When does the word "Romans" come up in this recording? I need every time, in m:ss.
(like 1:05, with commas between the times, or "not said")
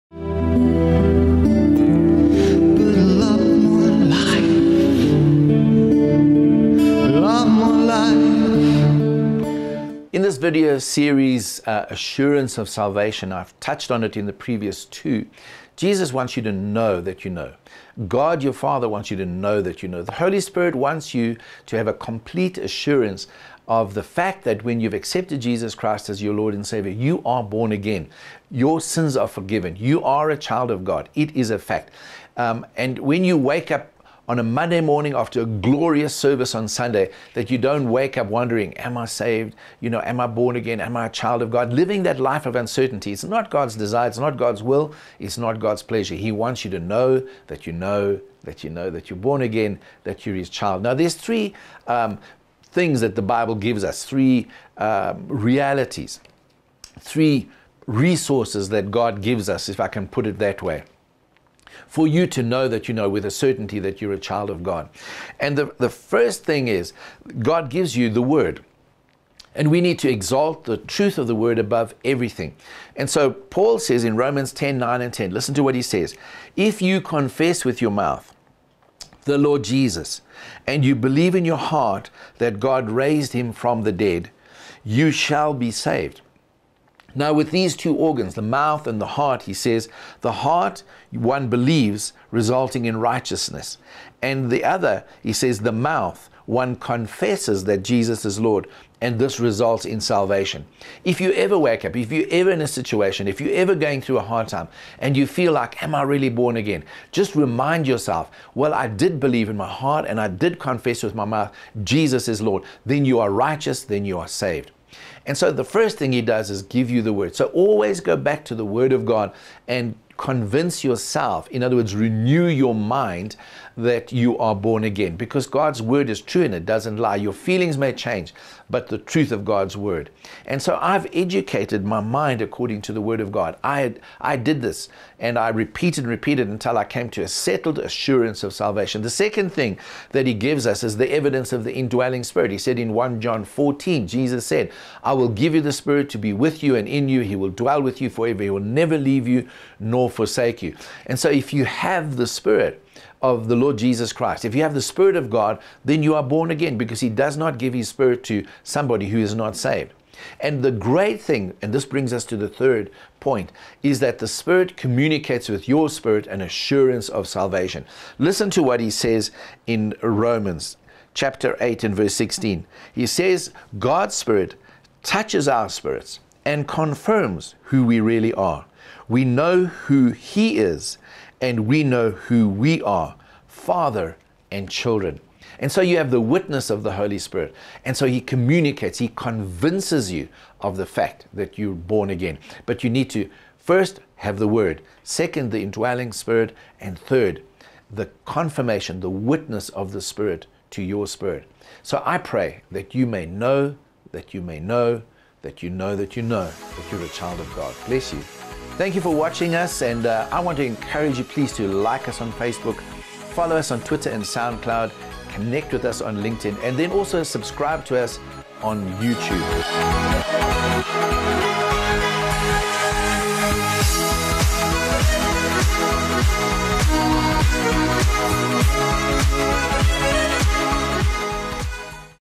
1:14, 2:50.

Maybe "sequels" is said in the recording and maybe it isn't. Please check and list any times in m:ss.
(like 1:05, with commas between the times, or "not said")
not said.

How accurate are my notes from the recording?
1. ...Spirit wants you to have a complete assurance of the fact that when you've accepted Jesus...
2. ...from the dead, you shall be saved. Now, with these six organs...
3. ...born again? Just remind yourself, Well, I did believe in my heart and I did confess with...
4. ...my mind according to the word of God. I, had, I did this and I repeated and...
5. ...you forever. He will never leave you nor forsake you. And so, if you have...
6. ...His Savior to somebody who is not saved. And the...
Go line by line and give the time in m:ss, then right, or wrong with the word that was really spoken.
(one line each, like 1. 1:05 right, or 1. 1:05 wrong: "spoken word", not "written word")
1. 0:20 right
2. 1:23 wrong: "two", not "six"
3. 1:46 right
4. 2:11 right
5. 2:28 right
6. 2:37 wrong: "Spirit", not "Savior".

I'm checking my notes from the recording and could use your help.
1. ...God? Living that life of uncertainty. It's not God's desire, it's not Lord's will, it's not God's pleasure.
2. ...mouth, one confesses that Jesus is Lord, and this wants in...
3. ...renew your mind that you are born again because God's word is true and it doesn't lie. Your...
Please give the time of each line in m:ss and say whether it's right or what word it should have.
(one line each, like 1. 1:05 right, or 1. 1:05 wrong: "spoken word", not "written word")
1. 0:41 wrong: "God", not "Lord"
2. 1:35 wrong: "results", not "wants"
3. 2:01 right.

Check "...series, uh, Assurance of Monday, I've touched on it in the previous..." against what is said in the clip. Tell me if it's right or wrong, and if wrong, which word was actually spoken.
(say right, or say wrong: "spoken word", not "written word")
wrong: "Salvation", not "Monday".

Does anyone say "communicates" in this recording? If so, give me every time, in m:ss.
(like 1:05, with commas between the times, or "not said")
2:44, 3:08.